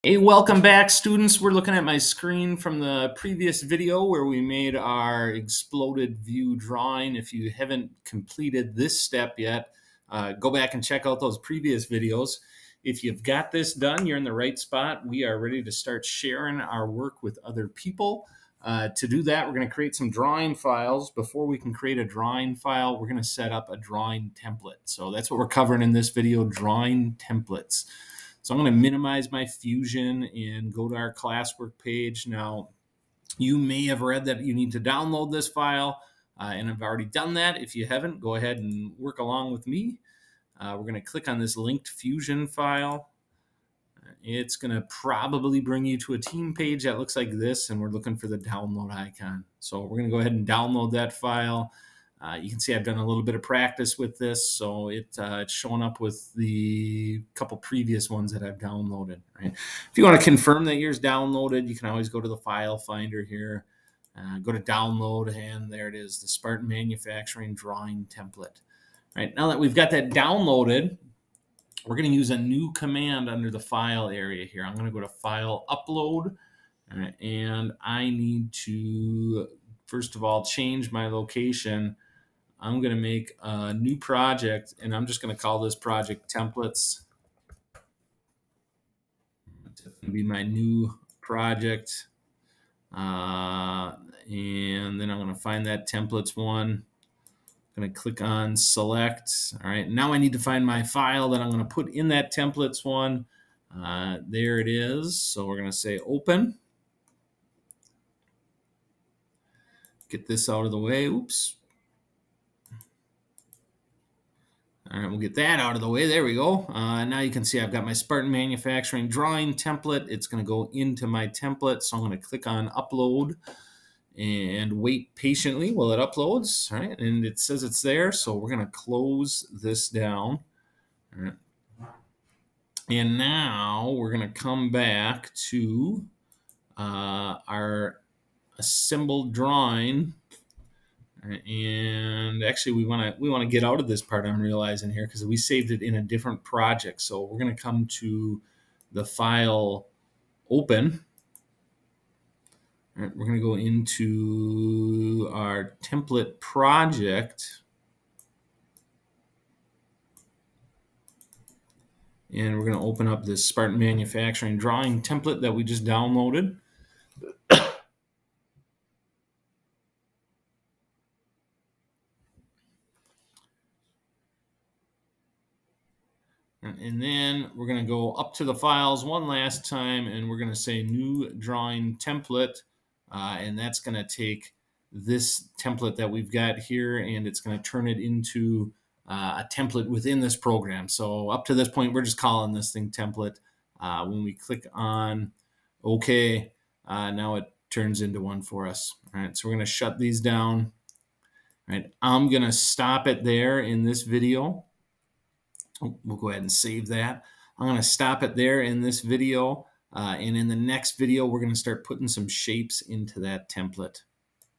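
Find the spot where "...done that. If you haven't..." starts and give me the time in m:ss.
0:37.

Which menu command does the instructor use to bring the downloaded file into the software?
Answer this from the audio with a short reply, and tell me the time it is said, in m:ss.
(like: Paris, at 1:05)
File Upload, at 1:15.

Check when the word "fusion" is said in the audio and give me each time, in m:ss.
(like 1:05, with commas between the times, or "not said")
0:29, 0:41.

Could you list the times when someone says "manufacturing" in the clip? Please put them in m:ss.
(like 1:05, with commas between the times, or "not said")
1:06, 1:58, 2:43.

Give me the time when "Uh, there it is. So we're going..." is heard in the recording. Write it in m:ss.
1:43.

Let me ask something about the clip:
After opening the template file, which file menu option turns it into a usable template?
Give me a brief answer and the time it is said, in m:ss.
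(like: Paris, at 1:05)
New drawing template, at 3:00.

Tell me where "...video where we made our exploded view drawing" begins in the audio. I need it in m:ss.
0:03.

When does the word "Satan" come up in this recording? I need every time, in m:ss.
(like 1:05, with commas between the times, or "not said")
not said.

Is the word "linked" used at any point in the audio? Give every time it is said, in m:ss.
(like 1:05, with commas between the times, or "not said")
0:41.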